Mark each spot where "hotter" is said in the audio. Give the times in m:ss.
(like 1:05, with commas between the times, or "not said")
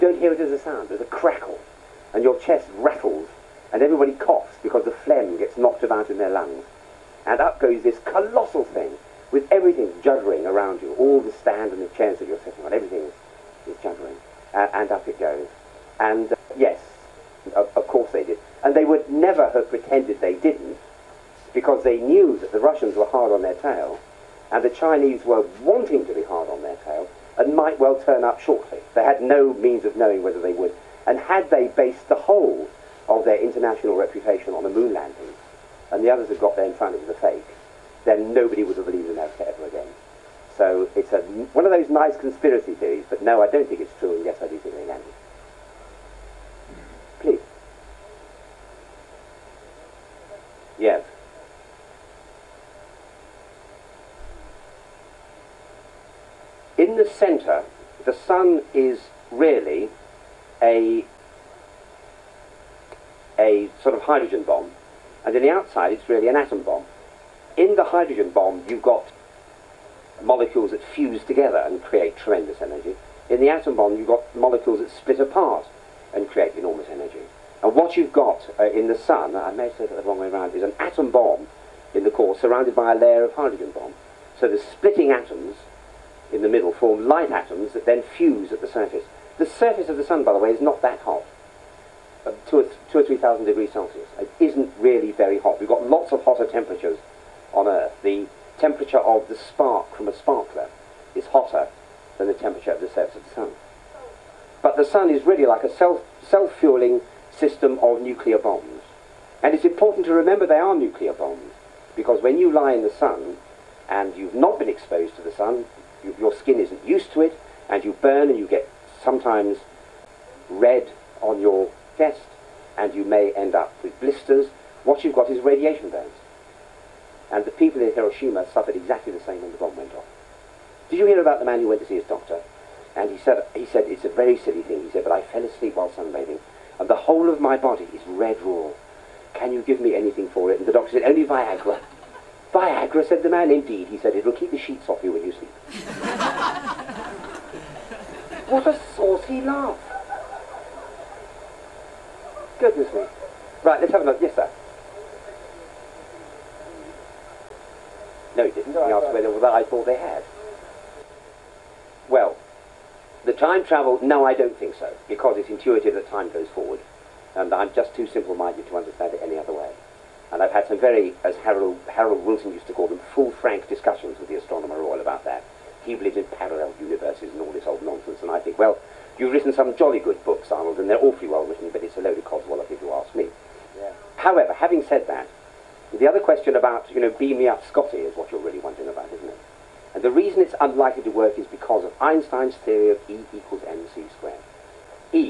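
1:36, 1:41.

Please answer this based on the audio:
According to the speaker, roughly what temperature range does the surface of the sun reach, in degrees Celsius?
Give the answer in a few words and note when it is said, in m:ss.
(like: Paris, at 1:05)
2 or 3 thousand degrees, at 1:32.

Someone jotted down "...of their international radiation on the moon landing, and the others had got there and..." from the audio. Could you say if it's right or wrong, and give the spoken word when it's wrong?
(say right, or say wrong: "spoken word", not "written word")
wrong: "reputation", not "radiation".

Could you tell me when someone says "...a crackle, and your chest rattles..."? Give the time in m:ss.
0:01.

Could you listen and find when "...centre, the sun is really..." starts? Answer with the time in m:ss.
0:57.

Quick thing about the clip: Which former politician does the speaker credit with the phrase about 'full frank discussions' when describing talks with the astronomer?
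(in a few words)
Harold Wilson.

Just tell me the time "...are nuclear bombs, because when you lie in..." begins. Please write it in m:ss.
1:50.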